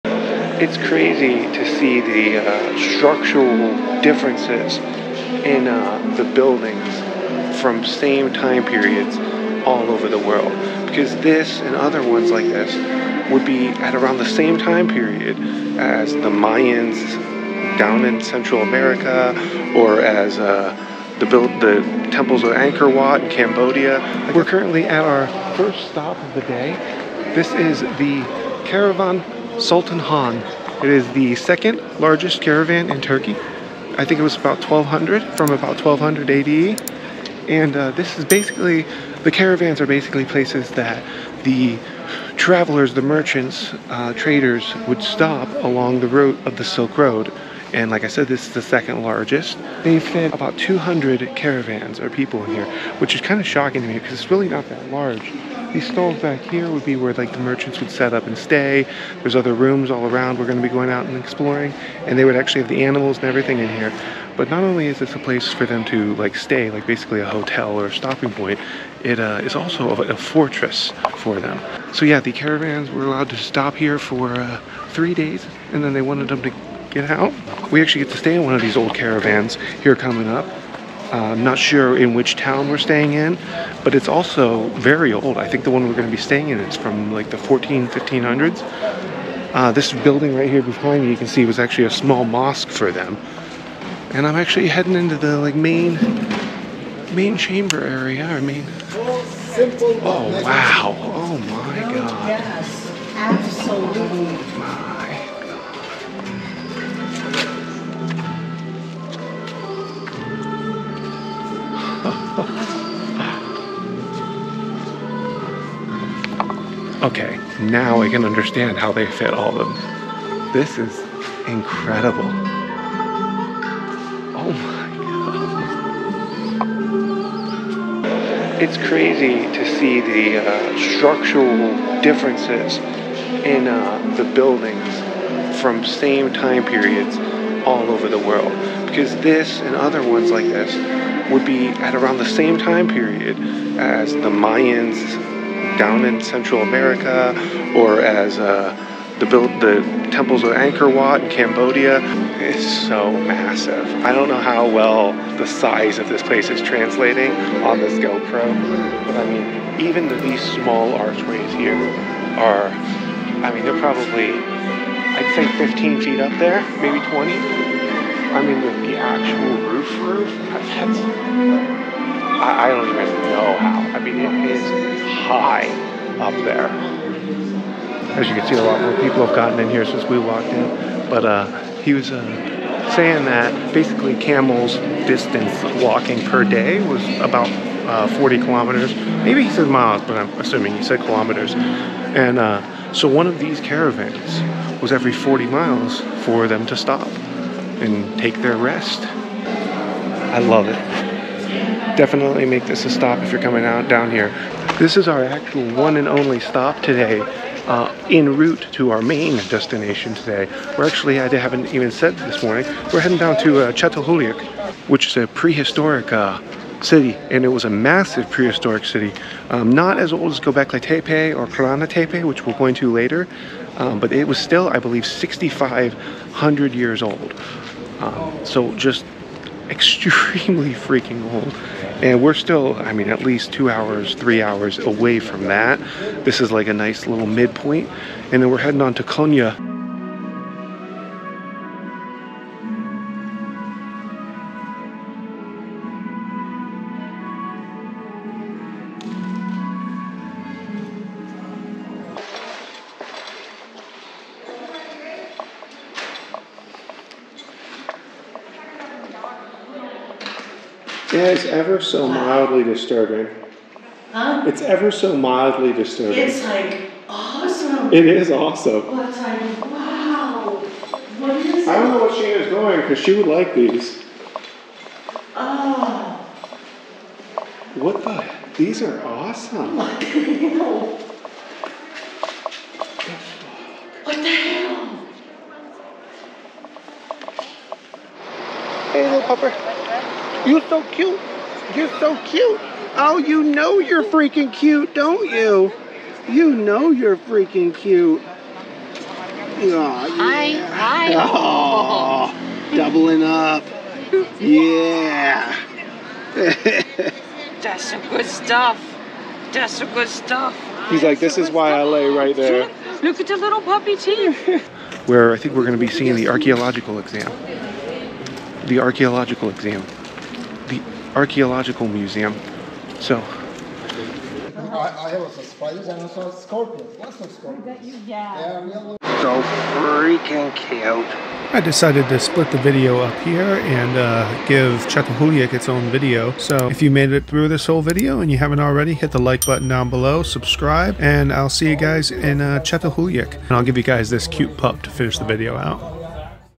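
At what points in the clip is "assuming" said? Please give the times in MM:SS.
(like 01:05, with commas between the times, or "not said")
03:10.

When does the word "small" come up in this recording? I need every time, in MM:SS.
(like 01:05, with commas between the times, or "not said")
01:31, 02:40.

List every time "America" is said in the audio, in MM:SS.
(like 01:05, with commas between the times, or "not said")
00:18, 02:26.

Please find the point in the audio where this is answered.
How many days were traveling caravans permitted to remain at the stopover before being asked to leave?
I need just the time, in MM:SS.
01:14.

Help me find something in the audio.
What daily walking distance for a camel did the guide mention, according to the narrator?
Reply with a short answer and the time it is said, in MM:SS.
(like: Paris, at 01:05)
40 kilometers, at 03:08.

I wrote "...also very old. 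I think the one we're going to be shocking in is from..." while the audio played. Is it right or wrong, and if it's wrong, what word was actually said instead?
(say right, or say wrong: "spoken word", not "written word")
wrong: "staying", not "shocking".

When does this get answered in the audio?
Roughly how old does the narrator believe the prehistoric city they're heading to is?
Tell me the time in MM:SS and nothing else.
03:45.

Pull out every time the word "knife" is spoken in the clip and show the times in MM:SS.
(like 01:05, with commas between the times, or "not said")
not said.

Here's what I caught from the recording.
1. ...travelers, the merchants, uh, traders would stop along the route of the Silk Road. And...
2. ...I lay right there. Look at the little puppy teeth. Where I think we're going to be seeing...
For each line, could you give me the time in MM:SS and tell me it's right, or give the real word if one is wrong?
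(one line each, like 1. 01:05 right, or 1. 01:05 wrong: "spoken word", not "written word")
1. 00:42 right
2. 05:11 right.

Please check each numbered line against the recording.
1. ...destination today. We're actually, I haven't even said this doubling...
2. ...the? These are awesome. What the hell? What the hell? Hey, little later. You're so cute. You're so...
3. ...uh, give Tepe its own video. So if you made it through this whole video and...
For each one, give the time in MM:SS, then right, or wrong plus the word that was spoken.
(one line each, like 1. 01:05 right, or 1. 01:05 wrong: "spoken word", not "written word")
1. 03:29 wrong: "morning", not "doubling"
2. 04:38 wrong: "pupper", not "later"
3. 05:33 wrong: "Çatalhöyük", not "Tepe".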